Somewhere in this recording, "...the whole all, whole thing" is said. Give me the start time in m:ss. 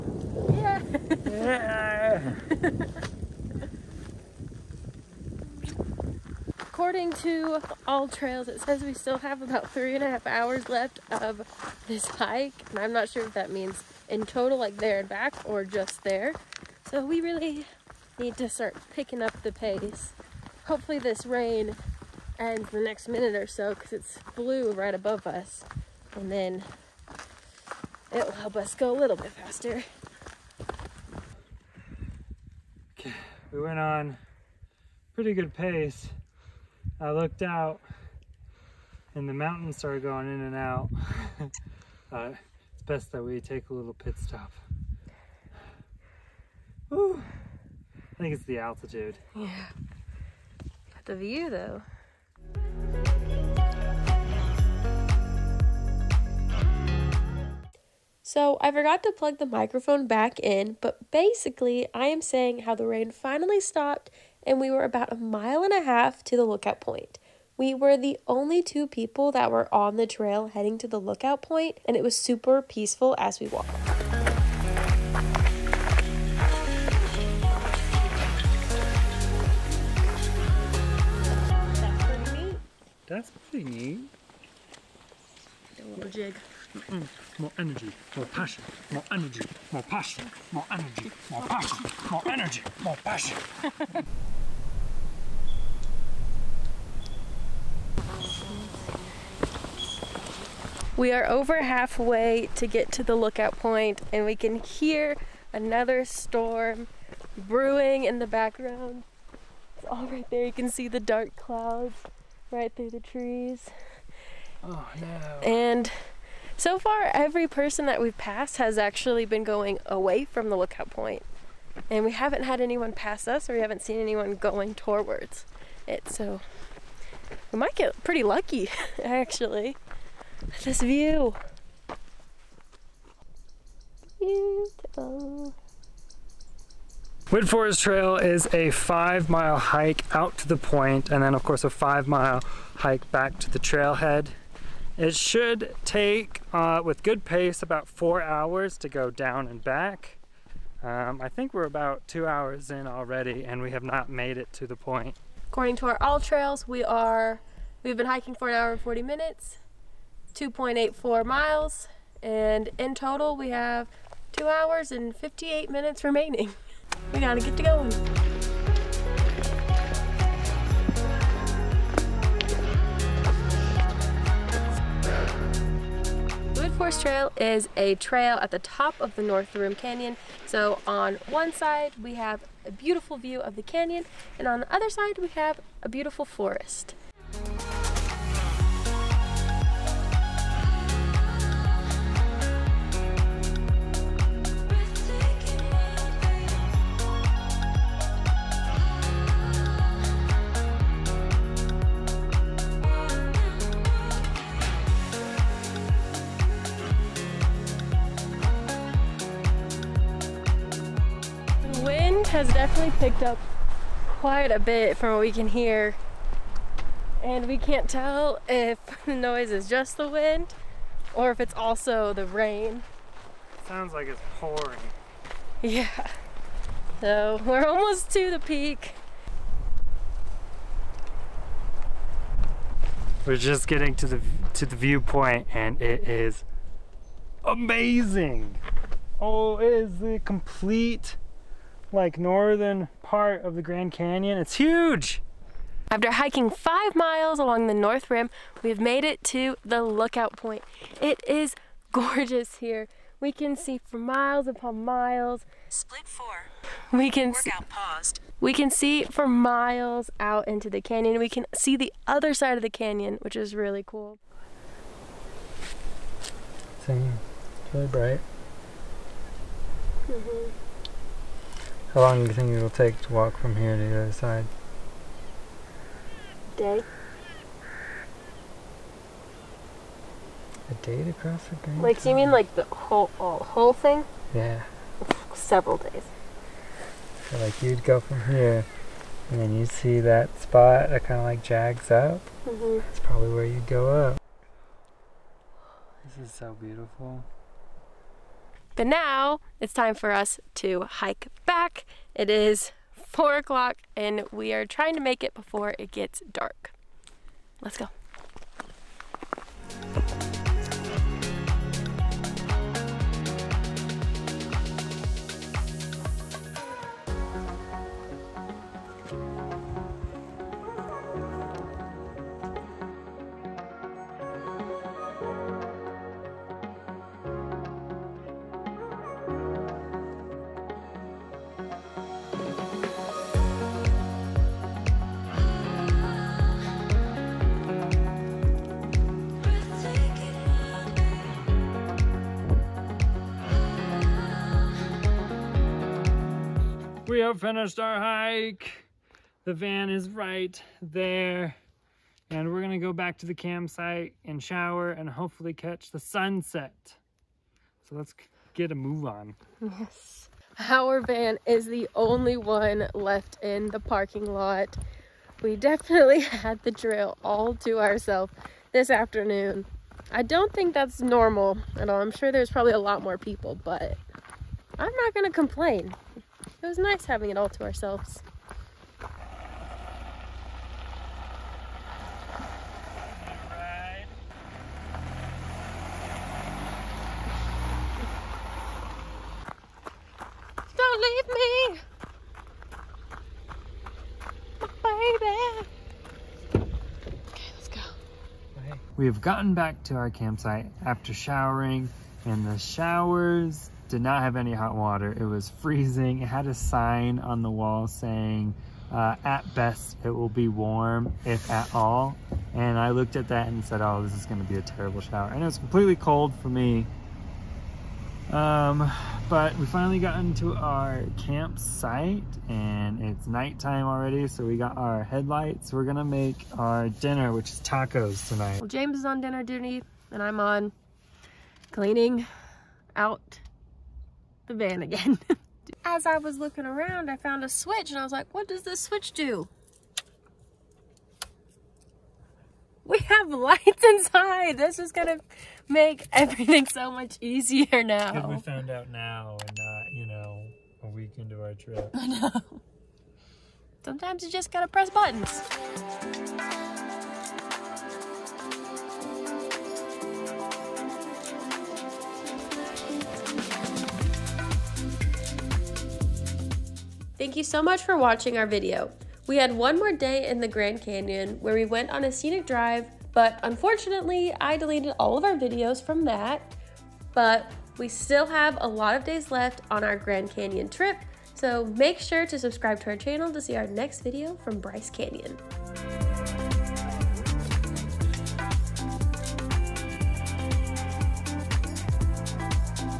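4:42.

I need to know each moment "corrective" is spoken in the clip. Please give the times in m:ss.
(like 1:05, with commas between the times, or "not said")
not said.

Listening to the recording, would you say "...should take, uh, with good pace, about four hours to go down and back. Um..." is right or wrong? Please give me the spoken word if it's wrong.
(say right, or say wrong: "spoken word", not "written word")
right.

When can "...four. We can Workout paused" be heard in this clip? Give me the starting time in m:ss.
4:16.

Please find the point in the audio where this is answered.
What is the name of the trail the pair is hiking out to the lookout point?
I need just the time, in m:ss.
2:17.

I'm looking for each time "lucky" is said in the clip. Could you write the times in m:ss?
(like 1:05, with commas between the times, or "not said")
2:08.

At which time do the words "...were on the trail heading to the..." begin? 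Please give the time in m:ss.
1:09.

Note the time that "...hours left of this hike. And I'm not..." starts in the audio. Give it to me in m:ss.
0:10.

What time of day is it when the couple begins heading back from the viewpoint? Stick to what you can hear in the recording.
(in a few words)
4 o'clock.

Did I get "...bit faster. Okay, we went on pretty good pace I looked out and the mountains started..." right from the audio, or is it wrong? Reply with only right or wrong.
right.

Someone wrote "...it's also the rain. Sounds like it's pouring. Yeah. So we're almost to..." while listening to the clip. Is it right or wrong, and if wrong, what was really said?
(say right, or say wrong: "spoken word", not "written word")
right.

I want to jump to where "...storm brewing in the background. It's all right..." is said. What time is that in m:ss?
1:46.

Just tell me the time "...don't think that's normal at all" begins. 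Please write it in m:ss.
6:10.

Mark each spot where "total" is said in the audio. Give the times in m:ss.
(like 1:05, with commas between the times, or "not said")
0:14, 2:42.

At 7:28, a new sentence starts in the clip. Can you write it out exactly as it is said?
we found out now and not, you know, a week into our trip.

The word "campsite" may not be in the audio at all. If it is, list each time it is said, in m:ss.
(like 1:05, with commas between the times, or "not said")
5:53, 6:40, 7:01.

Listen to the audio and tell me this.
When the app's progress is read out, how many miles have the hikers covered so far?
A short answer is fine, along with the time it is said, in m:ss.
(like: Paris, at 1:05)
2.84 miles, at 2:40.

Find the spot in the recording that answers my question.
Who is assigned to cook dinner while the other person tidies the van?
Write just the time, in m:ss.
7:08.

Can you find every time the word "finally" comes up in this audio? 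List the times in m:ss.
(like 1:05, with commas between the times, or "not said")
1:03, 6:59.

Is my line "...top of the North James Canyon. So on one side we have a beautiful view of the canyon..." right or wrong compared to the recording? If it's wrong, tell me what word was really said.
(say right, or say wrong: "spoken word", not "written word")
wrong: "Rim", not "James".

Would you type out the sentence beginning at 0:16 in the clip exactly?
So we really need to start picking up the pace.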